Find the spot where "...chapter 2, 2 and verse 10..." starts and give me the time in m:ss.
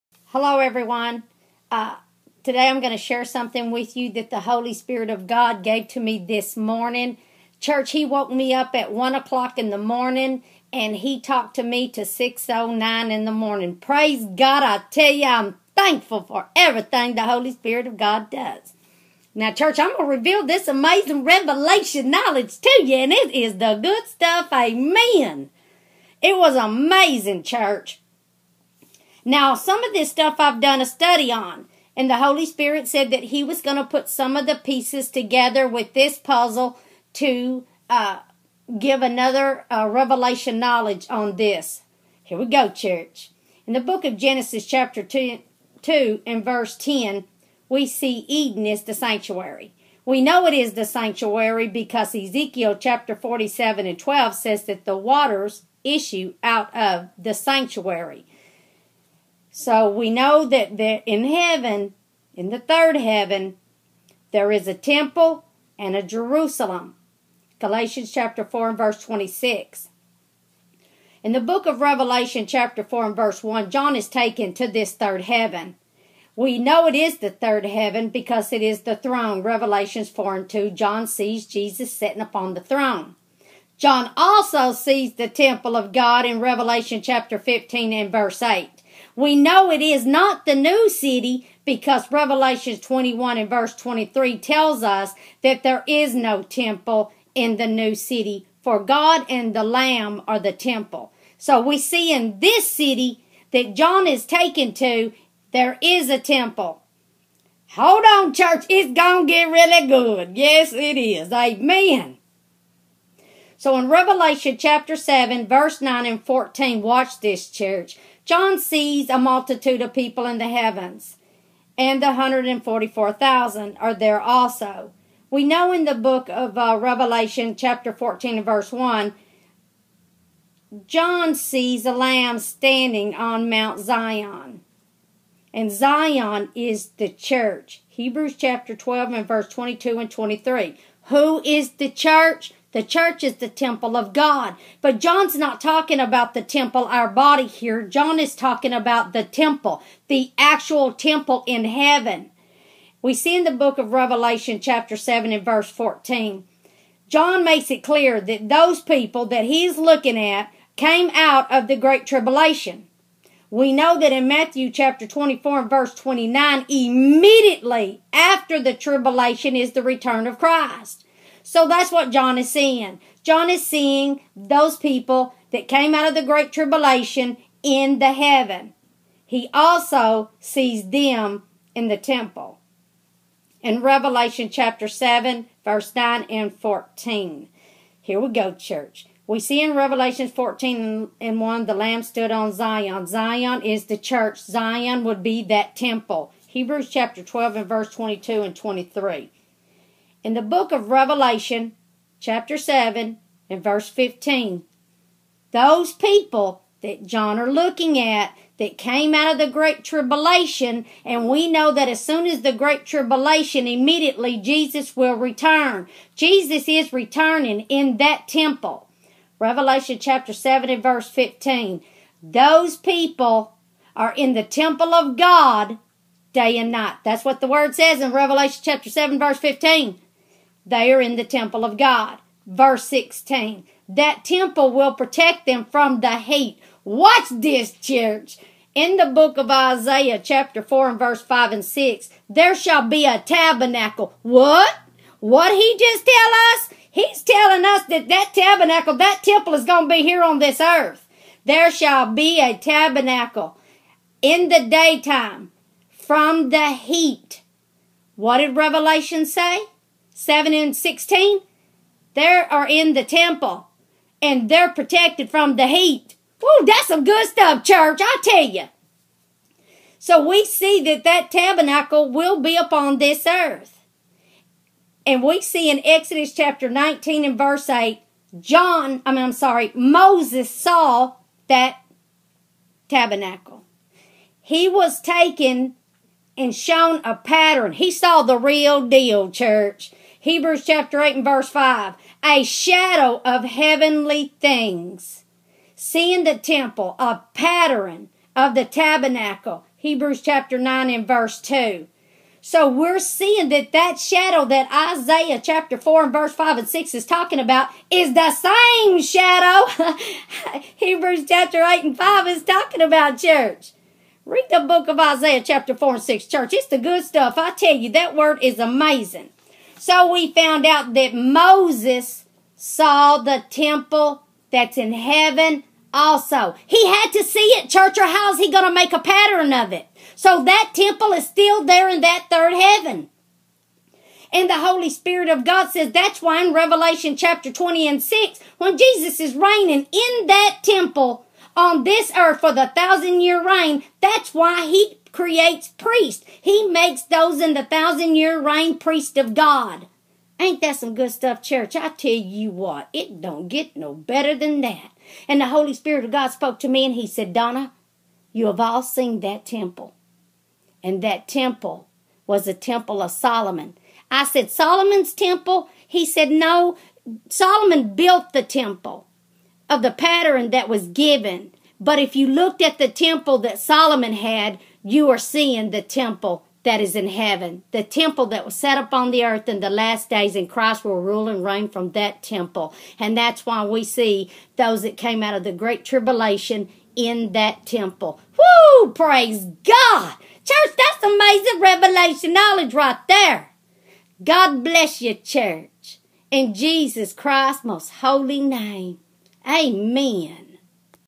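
0:44.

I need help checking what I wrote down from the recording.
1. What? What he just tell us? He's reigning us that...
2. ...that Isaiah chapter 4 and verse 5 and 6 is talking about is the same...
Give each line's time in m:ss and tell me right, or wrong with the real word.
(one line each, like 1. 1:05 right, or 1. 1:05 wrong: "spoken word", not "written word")
1. 4:04 wrong: "telling", not "reigning"
2. 5:04 right.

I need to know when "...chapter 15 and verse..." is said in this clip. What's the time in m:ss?
1:27.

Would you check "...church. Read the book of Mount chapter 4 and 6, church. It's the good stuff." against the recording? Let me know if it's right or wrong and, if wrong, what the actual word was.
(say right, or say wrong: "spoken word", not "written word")
wrong: "Isaiah", not "Mount".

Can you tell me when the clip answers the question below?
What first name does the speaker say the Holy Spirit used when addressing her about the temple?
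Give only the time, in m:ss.
5:57.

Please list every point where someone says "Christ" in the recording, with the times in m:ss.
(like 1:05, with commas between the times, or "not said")
2:50, 6:20, 6:37.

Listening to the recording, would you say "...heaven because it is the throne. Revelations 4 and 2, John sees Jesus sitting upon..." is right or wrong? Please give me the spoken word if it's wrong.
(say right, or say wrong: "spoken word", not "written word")
right.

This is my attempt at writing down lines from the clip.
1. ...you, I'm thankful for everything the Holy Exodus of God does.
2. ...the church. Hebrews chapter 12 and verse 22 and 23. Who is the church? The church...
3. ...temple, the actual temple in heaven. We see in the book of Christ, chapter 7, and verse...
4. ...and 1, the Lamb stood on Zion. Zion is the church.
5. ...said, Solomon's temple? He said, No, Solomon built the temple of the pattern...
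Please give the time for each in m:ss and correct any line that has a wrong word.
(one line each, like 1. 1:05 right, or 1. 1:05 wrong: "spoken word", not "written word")
1. 0:15 wrong: "Spirit", not "Exodus"
2. 2:16 right
3. 2:29 wrong: "Revelation", not "Christ"
4. 3:11 right
5. 6:04 right.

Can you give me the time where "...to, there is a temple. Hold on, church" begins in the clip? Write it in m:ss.
1:44.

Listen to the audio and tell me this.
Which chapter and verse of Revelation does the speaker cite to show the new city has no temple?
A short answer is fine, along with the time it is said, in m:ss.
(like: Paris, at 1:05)
Revelation 21:23, at 1:32.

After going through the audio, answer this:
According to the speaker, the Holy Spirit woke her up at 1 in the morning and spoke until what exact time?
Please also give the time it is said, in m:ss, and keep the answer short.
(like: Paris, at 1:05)
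6:09, at 0:12.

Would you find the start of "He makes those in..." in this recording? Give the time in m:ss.
5:46.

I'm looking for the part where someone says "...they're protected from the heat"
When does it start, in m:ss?
4:24.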